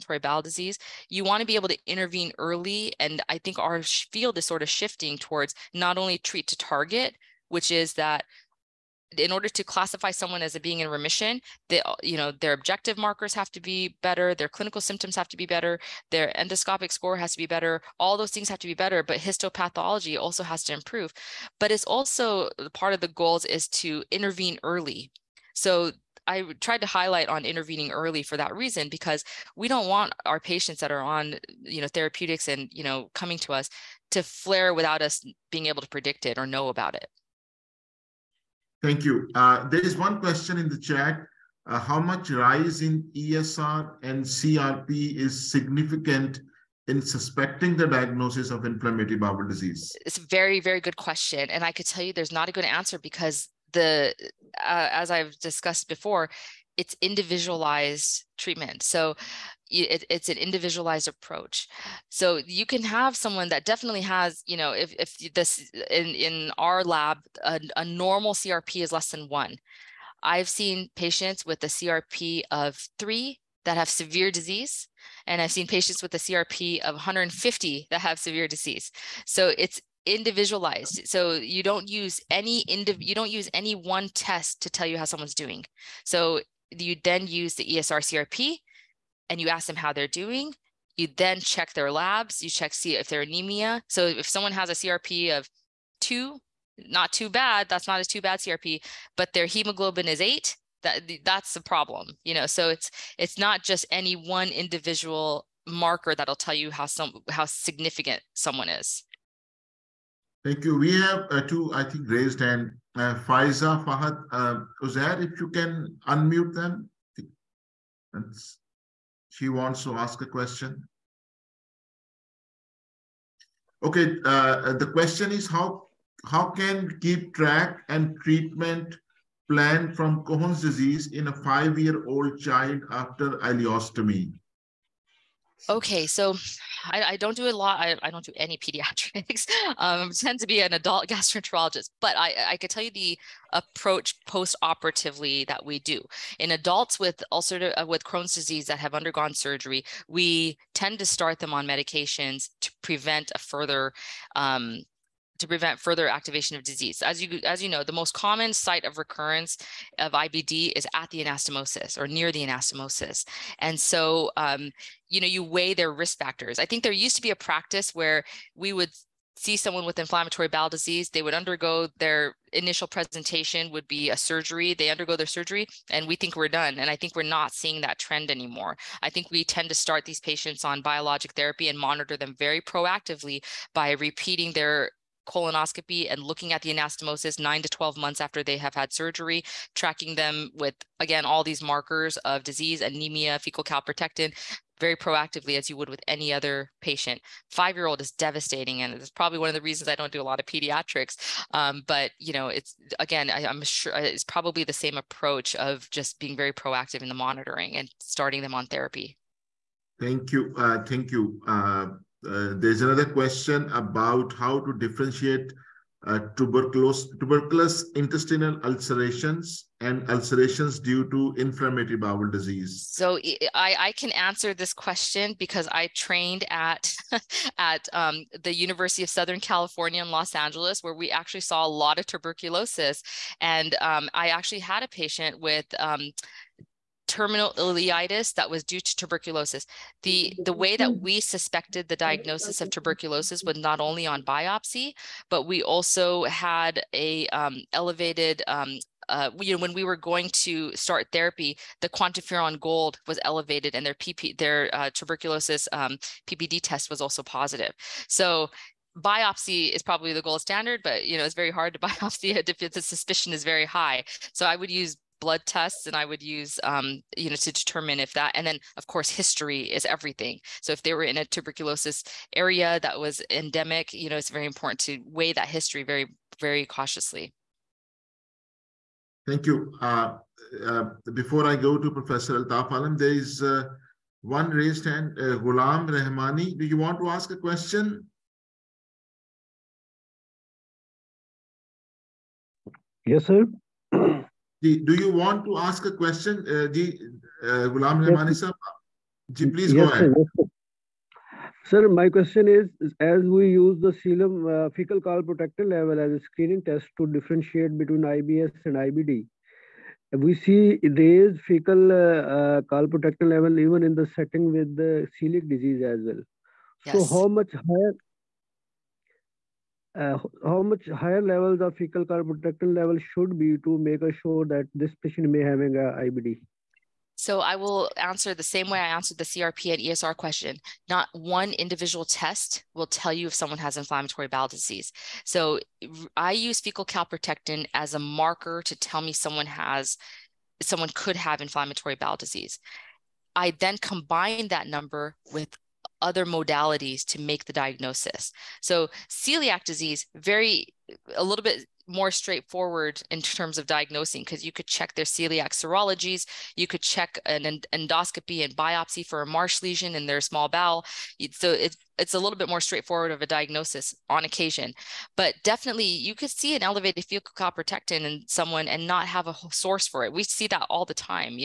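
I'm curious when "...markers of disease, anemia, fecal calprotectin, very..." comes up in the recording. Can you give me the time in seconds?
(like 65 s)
191 s.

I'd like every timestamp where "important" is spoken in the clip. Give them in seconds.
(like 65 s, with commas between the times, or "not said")
274 s.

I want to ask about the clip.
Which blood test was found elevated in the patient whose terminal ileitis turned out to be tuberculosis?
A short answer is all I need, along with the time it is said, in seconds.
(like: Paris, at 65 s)
QuantiFERON Gold, at 251 s.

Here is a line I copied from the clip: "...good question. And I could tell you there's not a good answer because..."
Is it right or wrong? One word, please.
right.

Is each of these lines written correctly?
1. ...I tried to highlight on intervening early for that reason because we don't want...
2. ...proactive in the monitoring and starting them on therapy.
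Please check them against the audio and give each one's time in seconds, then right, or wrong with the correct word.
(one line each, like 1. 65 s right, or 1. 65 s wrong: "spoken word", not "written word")
1. 26 s right
2. 206 s right.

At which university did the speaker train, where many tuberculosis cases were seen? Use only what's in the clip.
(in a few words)
University of Southern California.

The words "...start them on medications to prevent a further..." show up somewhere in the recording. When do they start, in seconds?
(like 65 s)
151 s.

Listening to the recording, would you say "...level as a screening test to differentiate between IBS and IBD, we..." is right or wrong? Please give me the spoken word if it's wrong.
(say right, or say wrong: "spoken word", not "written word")
right.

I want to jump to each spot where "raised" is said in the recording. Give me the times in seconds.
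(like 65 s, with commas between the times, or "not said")
112 s, 284 s, 310 s.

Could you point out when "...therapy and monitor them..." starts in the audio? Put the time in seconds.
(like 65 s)
181 s.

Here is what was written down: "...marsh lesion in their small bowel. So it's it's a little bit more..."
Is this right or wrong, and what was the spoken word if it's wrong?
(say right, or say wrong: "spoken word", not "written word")
right.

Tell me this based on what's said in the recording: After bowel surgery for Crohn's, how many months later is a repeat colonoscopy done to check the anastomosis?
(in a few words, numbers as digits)
9 to 12 months.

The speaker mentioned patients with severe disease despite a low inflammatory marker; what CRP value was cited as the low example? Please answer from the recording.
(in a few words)
3.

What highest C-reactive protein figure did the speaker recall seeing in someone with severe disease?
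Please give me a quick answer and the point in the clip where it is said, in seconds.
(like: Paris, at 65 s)
150, at 76 s.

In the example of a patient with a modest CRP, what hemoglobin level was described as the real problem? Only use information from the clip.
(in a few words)
8.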